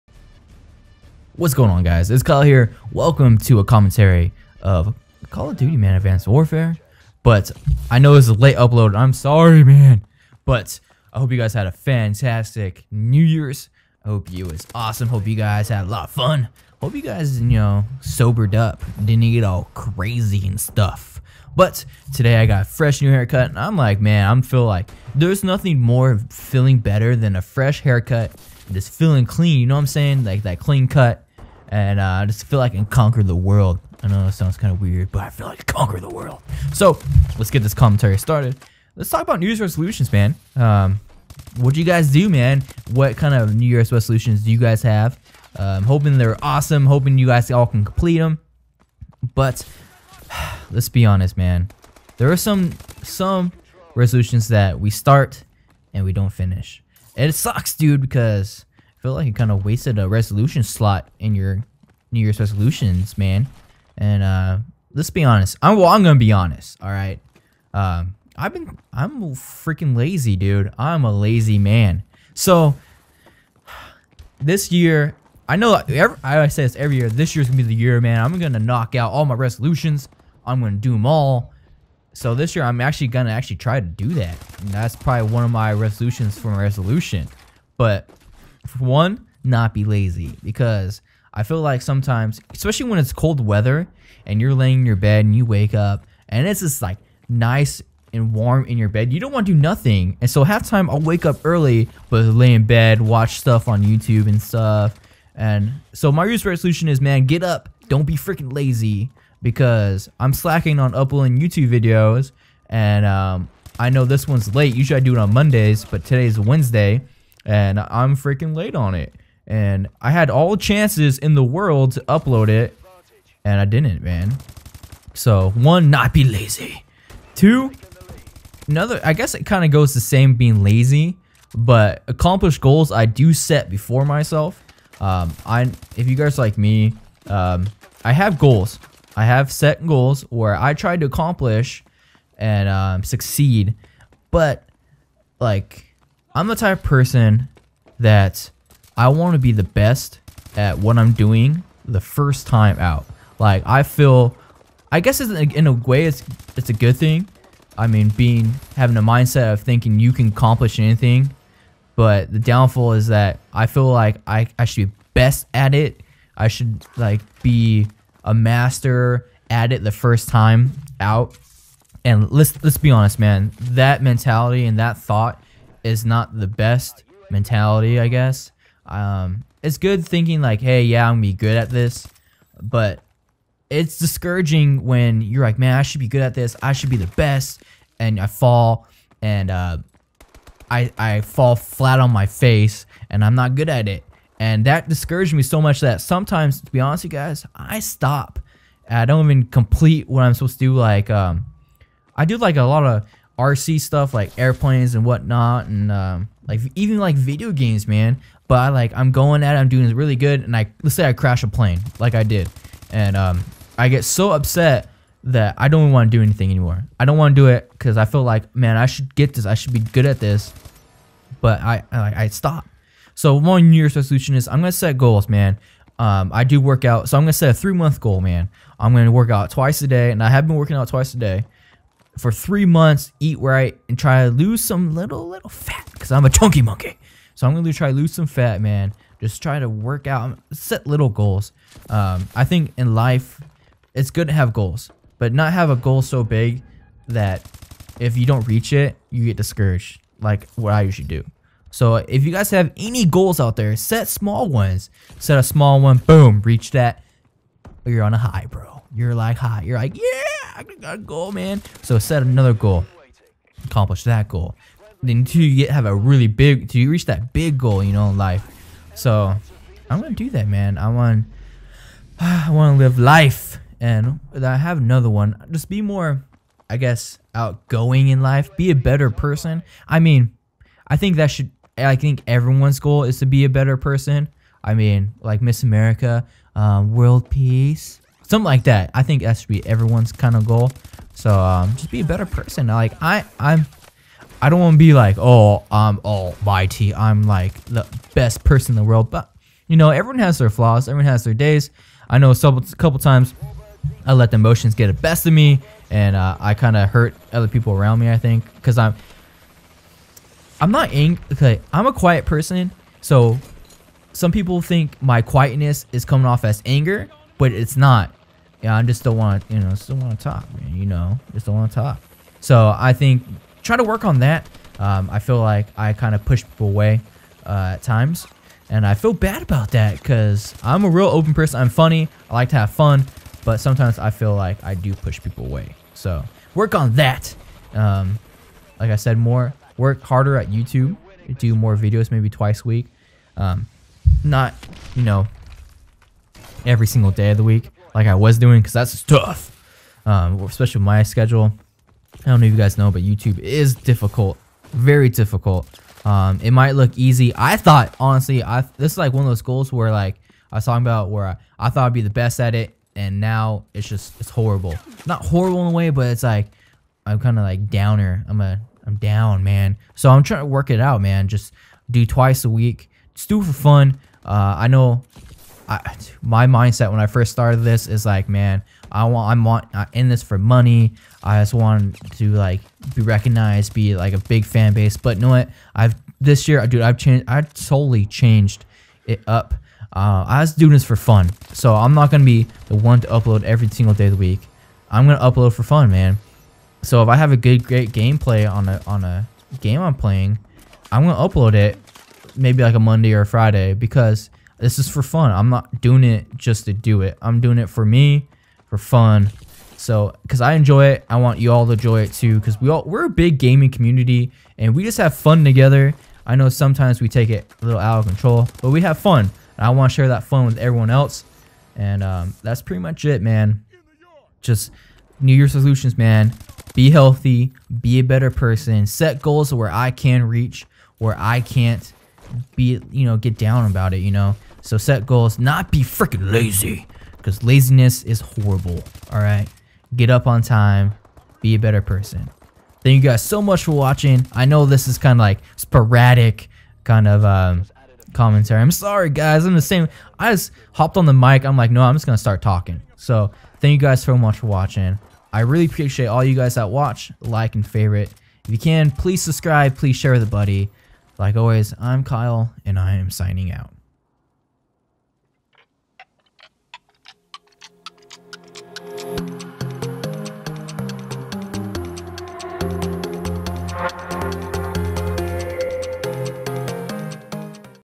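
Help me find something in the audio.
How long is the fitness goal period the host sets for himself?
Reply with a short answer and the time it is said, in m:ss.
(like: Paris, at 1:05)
3 months, at 3:47.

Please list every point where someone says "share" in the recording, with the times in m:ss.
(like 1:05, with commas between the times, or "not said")
6:59, 7:39.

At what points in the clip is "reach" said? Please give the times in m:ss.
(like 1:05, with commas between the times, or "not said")
4:08, 4:16, 4:26, 7:10.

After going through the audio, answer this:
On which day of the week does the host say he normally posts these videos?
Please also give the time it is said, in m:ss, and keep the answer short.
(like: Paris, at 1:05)
Monday, at 1:55.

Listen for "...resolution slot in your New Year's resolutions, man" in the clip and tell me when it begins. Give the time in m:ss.
1:00.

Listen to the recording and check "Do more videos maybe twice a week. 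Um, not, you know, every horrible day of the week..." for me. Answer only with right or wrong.
wrong.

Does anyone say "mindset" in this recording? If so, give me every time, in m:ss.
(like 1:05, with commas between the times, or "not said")
2:39, 6:16.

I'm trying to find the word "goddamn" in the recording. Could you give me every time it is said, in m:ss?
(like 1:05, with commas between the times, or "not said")
not said.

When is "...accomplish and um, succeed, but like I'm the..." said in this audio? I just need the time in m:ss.
2:21.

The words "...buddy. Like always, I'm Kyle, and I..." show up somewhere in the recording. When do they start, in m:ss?
7:40.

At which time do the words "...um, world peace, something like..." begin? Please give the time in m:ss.
4:46.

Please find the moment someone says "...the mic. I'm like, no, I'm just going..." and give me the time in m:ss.
7:31.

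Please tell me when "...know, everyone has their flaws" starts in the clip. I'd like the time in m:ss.
4:59.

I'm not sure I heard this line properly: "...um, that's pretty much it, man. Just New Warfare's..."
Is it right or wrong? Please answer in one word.
wrong.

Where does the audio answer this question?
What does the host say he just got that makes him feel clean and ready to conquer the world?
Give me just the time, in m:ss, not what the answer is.
0:22.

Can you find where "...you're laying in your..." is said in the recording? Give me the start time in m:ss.
1:34.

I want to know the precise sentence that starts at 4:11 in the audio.
So if you guys have any goals out there, set small ones.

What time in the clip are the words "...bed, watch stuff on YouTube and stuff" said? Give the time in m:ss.
1:42.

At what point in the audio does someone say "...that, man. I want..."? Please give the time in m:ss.
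4:30.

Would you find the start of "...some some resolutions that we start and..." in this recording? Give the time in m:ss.
0:52.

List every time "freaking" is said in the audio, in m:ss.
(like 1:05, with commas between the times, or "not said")
1:09, 1:48, 1:58, 7:15.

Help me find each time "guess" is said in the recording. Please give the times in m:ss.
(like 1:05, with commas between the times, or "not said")
2:09, 2:35, 2:58, 4:36.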